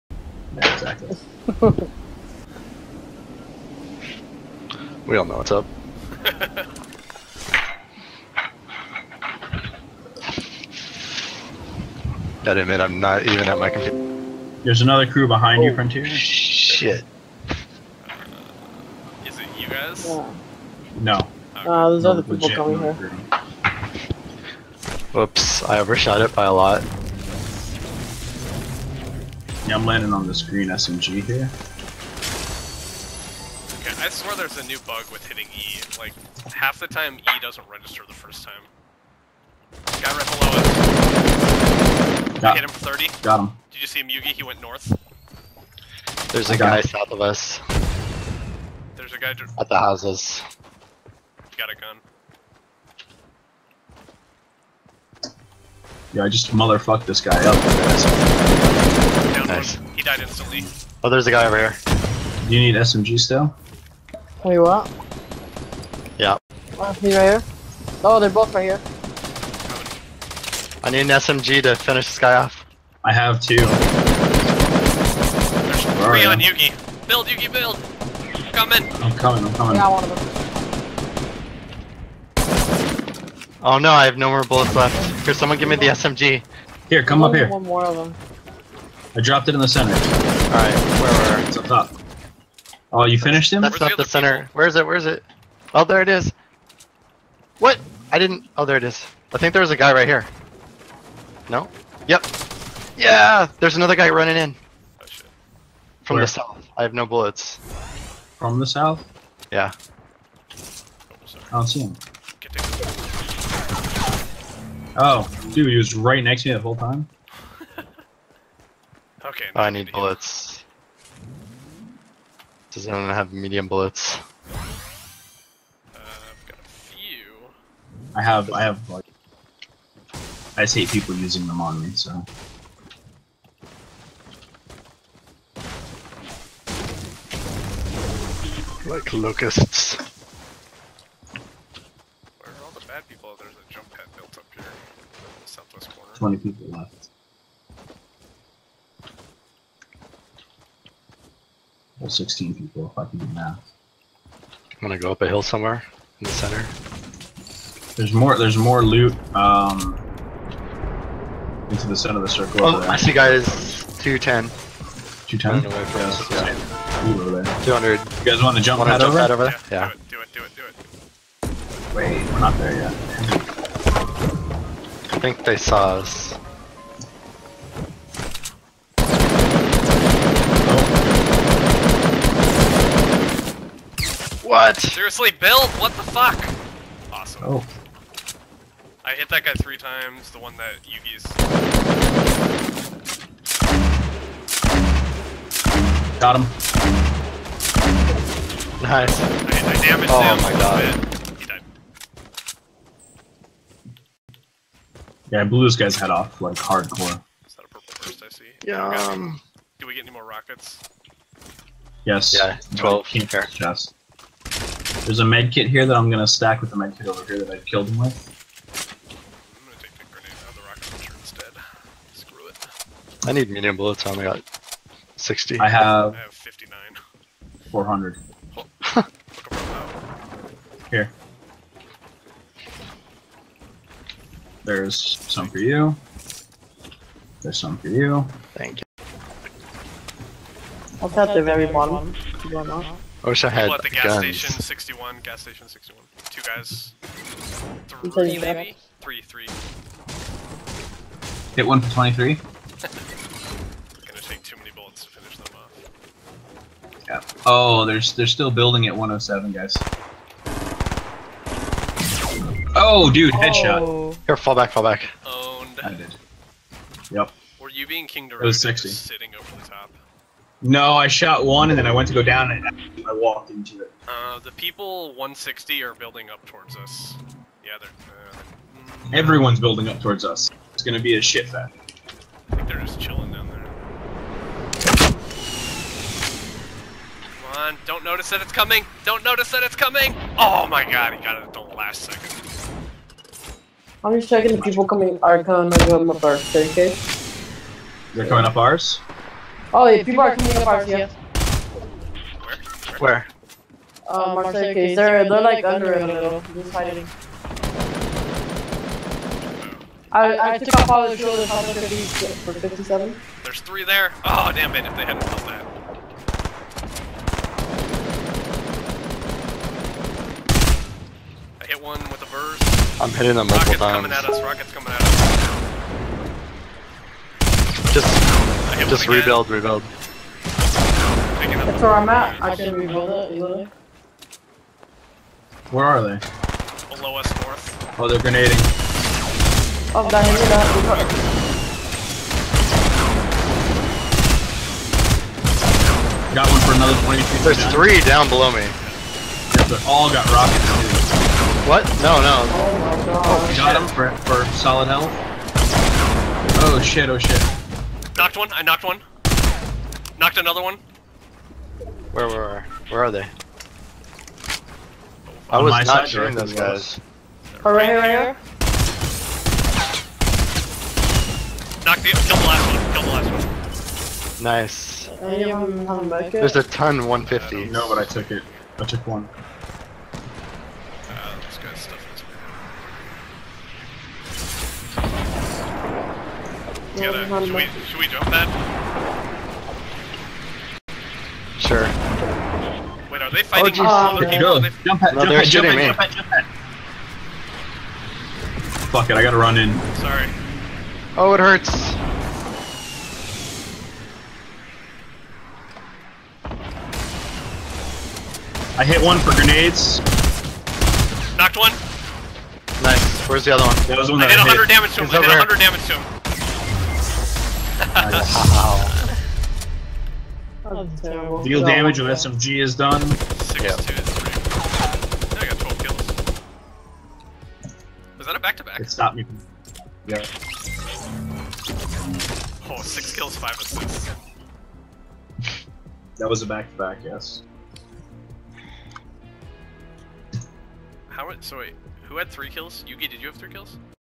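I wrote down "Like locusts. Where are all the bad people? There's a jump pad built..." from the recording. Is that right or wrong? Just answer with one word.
right.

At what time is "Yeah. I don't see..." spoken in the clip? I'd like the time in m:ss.
1:49.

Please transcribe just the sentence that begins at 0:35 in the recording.
Like, half the time E doesn't register the first time.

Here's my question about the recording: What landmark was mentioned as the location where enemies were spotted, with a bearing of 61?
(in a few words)
gas station.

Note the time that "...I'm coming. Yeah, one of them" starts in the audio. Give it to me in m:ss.
1:19.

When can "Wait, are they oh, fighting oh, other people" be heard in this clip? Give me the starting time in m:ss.
6:33.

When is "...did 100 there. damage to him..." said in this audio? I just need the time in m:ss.
6:55.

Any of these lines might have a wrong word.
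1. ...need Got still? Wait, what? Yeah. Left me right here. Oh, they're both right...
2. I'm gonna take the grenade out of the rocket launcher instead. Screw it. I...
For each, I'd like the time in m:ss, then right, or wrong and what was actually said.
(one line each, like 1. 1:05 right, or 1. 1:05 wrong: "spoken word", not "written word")
1. 1:02 wrong: "SMG", not "Got"
2. 3:38 right.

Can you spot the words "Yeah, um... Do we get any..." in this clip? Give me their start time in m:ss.
3:28.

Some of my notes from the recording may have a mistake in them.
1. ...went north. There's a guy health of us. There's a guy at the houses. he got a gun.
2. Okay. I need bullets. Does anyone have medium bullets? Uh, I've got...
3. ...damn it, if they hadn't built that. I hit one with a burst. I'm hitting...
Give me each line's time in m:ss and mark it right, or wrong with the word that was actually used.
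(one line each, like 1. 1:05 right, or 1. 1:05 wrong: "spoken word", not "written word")
1. 0:44 wrong: "south", not "health"
2. 1:59 right
3. 5:14 right.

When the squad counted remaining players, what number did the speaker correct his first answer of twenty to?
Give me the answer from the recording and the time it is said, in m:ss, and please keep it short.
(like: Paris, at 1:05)
16, at 2:32.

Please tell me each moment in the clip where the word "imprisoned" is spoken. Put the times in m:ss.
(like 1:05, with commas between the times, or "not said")
not said.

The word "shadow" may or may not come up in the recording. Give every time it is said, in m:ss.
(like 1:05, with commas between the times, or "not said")
not said.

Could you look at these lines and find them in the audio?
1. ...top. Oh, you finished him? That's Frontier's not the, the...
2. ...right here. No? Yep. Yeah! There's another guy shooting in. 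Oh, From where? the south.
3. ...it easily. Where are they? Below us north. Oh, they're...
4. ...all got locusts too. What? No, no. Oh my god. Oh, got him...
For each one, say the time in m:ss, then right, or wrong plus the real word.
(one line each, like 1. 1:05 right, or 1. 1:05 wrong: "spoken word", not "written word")
1. 1:31 wrong: "Where", not "Frontier"
2. 1:39 wrong: "running", not "shooting"
3. 5:33 right
4. 5:49 wrong: "rockets", not "locusts".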